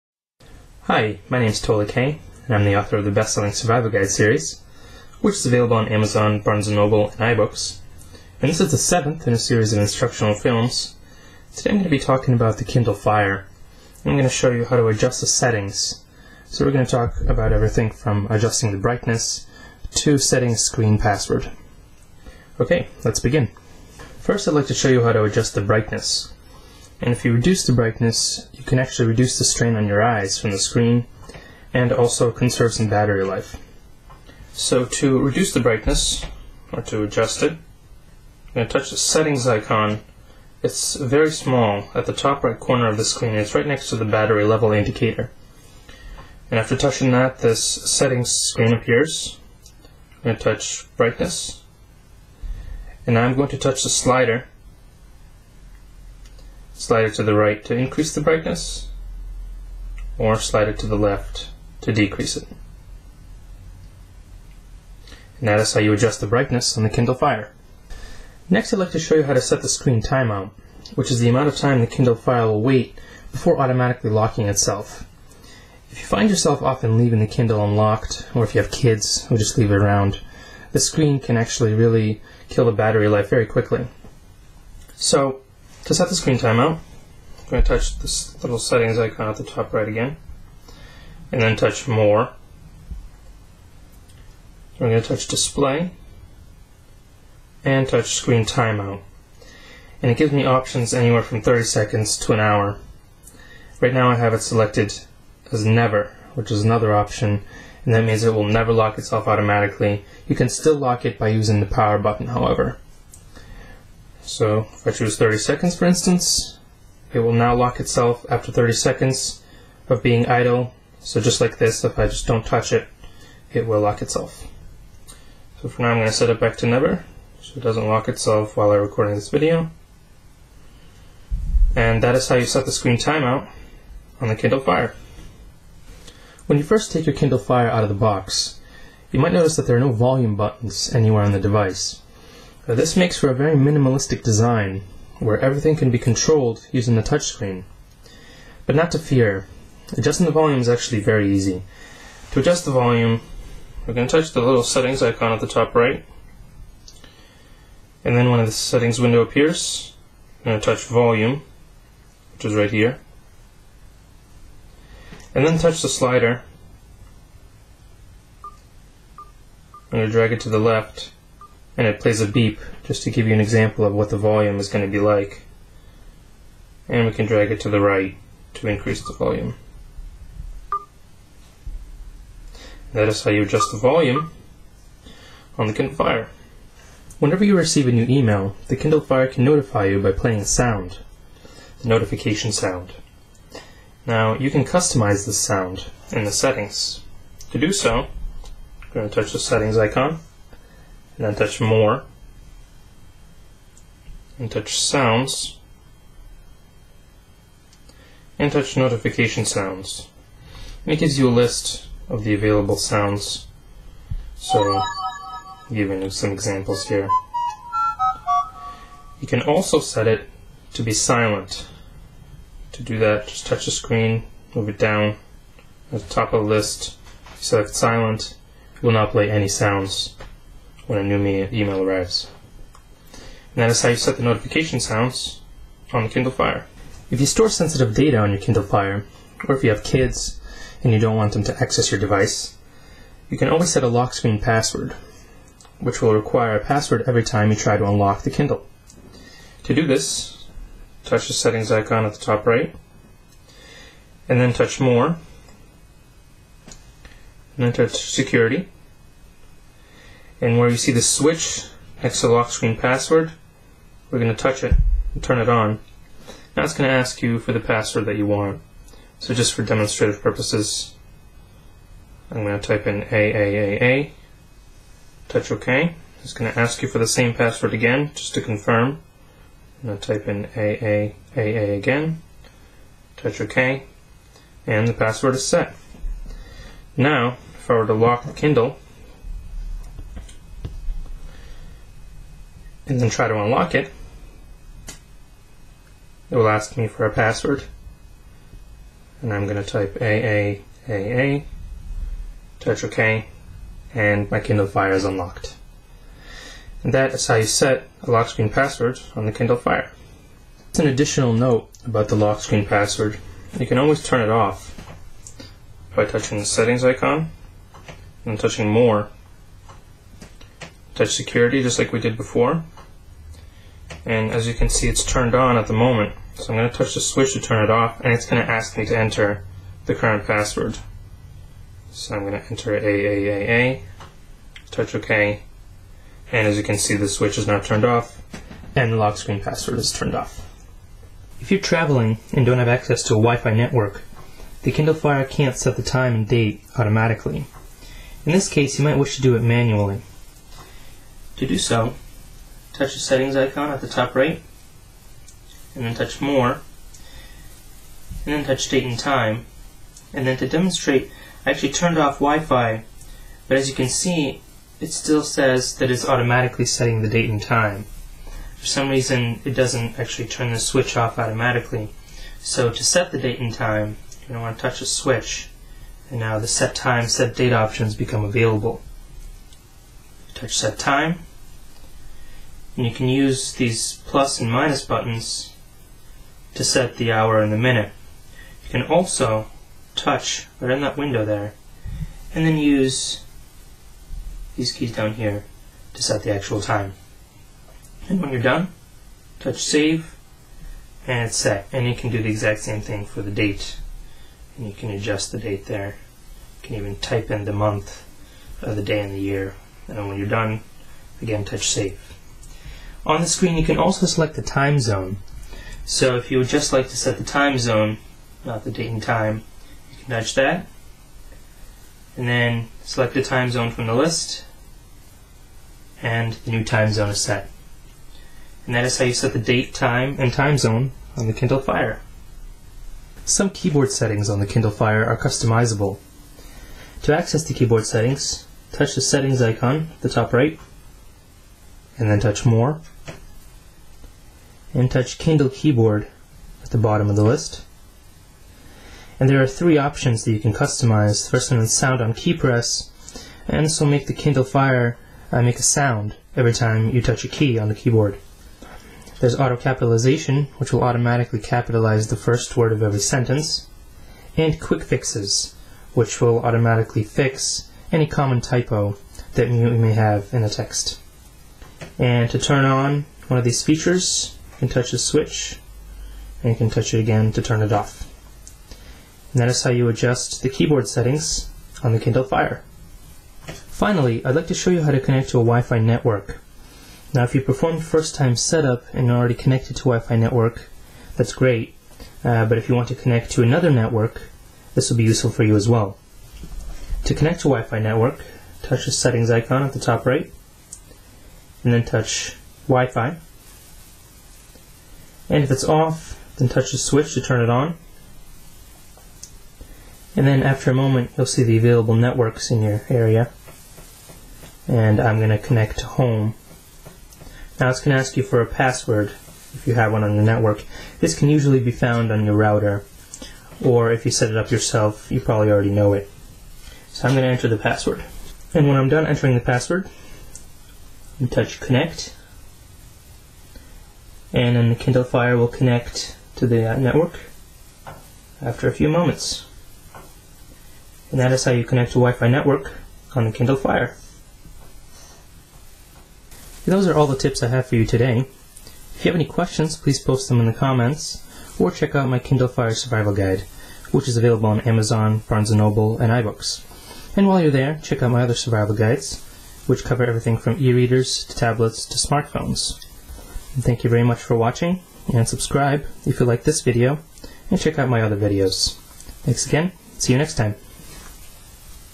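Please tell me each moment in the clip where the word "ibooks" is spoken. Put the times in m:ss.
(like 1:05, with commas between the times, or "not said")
0:07, 9:16.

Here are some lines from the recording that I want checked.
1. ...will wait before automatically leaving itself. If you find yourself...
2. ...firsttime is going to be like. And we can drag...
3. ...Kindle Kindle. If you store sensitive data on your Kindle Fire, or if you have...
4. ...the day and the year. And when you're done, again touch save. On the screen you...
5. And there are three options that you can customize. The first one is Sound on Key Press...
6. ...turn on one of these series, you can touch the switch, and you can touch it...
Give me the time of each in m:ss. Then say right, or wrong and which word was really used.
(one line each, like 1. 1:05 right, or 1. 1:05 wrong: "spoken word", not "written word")
1. 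1:12 wrong: "locking", not "leaving"
2. 2:54 wrong: "volume", not "firsttime"
3. 3:56 wrong: "Fire", not "Kindle"
4. 6:48 right
5. 7:29 right
6. 7:52 wrong: "features", not "series".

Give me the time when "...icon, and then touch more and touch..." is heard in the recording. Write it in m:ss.
3:19.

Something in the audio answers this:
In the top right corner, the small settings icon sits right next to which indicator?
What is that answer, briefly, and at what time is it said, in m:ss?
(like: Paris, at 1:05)
battery level indicator, at 0:44.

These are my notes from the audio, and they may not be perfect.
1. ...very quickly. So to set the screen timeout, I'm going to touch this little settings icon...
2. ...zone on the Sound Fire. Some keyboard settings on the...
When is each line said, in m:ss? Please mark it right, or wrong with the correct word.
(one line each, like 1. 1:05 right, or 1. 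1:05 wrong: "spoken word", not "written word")
1. 1:23 right
2. 7:10 wrong: "Kindle", not "Sound".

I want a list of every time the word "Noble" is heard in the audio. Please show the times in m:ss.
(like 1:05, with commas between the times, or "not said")
0:06, 9:15.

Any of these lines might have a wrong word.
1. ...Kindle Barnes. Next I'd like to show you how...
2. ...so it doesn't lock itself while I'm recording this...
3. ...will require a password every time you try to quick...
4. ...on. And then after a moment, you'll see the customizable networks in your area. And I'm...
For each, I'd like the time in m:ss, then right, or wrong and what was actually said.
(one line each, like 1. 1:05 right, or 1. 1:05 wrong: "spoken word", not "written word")
1. 1:06 wrong: "Fire", not "Barnes"
2. 2:07 right
3. 4:06 wrong: "unlock", not "quick"
4. 8:27 wrong: "available", not "customizable".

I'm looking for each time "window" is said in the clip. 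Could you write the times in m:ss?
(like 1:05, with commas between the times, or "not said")
2:39, 6:30.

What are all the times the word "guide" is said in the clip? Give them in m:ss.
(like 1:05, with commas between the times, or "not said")
0:03, 9:13, 9:18.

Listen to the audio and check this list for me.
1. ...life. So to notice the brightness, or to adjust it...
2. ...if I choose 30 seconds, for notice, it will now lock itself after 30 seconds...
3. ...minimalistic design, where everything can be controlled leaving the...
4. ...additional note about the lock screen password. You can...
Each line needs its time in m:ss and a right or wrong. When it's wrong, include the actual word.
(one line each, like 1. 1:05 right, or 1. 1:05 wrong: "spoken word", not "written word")
1. 0:33 wrong: "reduce", not "notice"
2. 1:54 wrong: "instance", not "notice"
3. 2:23 wrong: "using", not "leaving"
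4. 5:10 right.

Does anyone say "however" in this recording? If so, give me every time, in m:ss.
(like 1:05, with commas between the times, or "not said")
1:52.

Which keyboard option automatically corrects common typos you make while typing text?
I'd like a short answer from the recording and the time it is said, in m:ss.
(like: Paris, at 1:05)
quick fixes, at 7:44.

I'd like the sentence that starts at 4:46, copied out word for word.
Now, if I were to lock the Kindle, and then try to unlock it, it will ask me for a password.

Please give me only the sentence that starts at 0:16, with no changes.
So we're going to talk about everything from adjusting the brightness to setting screen password.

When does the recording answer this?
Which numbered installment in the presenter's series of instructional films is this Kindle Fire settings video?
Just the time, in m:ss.
0:08.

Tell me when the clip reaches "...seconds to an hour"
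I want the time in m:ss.
1:41.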